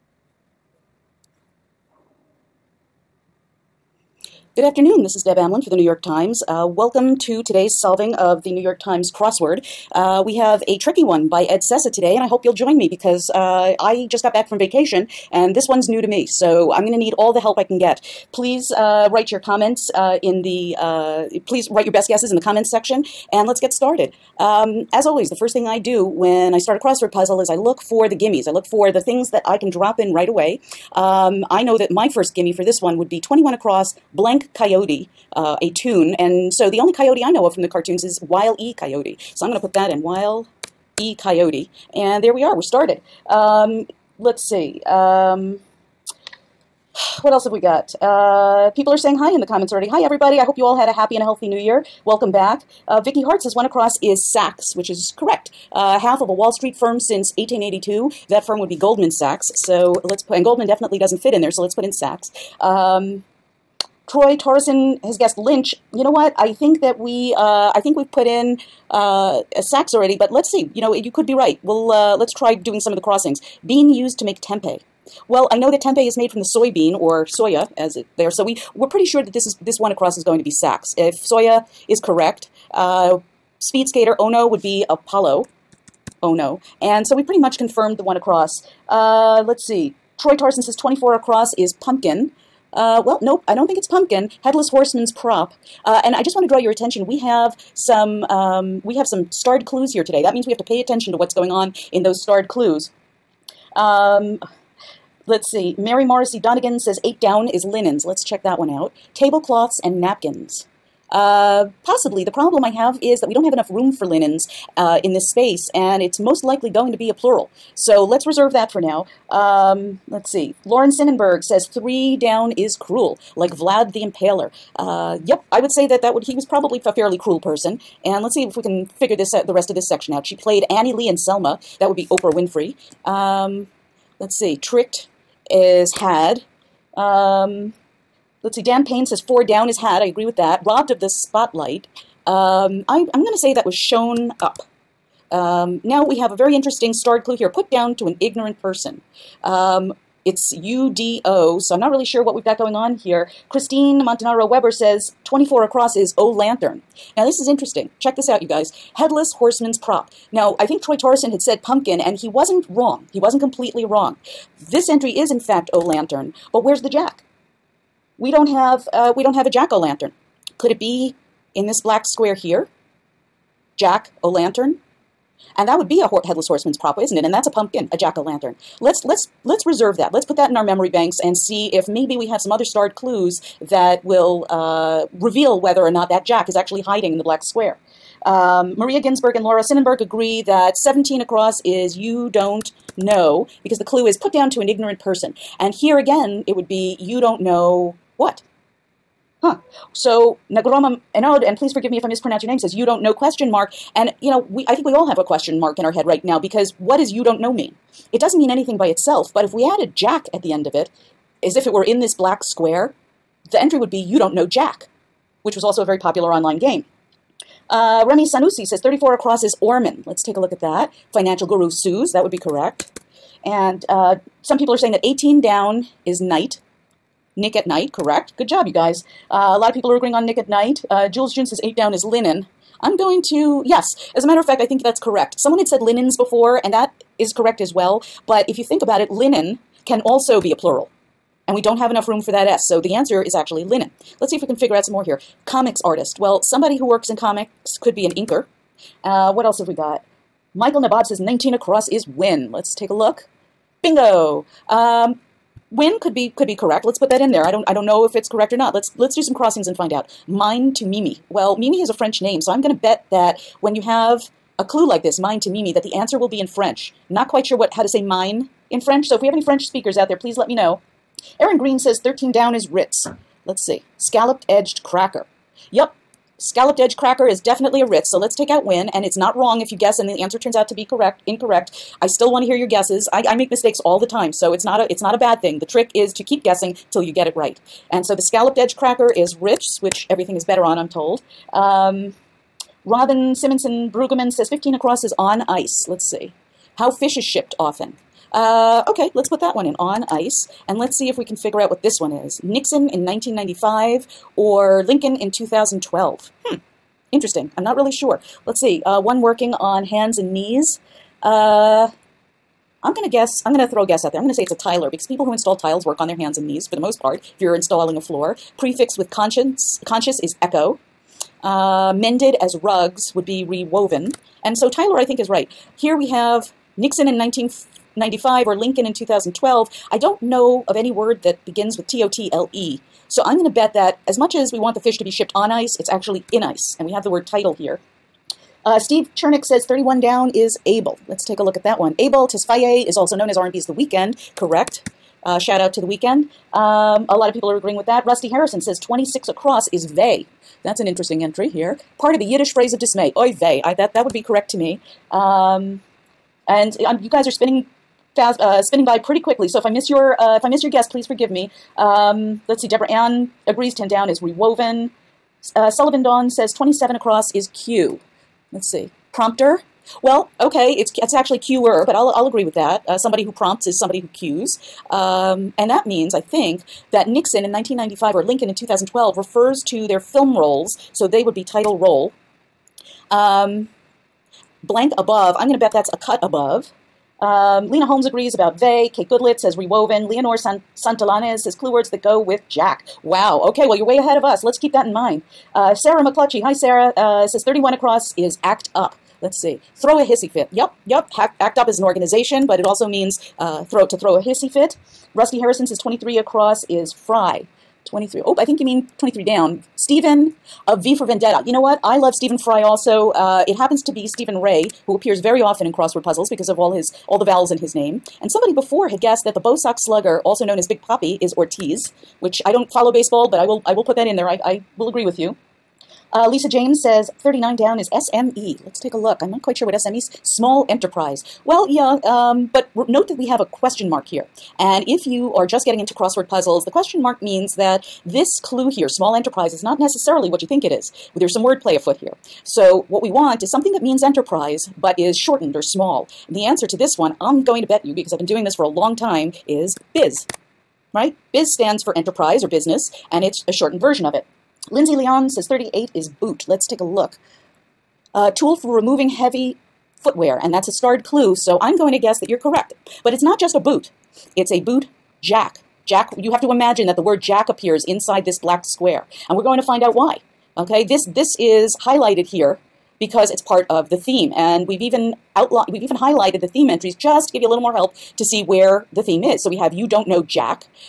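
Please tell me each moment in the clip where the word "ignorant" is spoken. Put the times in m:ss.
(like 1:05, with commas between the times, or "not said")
2:28, 3:14.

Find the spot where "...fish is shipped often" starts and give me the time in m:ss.
4:56.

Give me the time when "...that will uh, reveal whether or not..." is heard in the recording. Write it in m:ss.
3:03.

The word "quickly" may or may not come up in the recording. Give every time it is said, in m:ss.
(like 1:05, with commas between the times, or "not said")
5:59.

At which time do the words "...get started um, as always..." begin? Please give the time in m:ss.
0:23.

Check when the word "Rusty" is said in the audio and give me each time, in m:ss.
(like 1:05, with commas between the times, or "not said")
5:48, 6:45.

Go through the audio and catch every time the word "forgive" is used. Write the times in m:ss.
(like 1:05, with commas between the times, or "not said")
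3:21, 6:01.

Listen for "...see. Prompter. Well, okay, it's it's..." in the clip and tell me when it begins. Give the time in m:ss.
6:08.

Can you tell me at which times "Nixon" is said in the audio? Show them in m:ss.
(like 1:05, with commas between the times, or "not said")
5:02, 5:26, 6:17.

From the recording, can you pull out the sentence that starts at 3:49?
Uh, a lot of people are agreeing on Nick at Night.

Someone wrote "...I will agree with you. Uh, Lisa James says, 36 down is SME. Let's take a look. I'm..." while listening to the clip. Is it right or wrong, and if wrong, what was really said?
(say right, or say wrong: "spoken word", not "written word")
wrong: "39", not "36".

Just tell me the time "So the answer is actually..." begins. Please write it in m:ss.
4:02.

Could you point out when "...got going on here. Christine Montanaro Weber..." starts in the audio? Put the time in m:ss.
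2:32.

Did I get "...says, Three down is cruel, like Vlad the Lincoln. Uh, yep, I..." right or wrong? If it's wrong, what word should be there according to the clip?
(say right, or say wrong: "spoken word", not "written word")
wrong: "Impaler", not "Lincoln".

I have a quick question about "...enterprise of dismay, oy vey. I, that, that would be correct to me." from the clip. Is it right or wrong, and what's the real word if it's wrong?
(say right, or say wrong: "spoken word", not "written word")
wrong: "phrase", not "enterprise".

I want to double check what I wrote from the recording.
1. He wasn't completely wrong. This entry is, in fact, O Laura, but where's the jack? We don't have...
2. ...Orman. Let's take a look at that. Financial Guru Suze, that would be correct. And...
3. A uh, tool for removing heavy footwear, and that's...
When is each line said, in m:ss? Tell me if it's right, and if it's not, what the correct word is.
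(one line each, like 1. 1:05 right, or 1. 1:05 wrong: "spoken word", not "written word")
1. 2:43 wrong: "Lantern", not "Laura"
2. 3:39 right
3. 7:38 right.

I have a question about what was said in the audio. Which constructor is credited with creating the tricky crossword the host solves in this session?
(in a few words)
Ed Sessa.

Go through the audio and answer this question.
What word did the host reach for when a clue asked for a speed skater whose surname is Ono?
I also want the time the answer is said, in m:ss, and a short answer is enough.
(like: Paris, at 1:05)
Apollo, at 1:24.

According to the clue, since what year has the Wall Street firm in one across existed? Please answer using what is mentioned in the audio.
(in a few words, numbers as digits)
1882.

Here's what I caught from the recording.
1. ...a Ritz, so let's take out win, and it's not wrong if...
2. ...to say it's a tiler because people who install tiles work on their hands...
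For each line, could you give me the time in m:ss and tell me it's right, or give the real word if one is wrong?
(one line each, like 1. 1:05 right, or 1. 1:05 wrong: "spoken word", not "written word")
1. 4:37 right
2. 5:14 right.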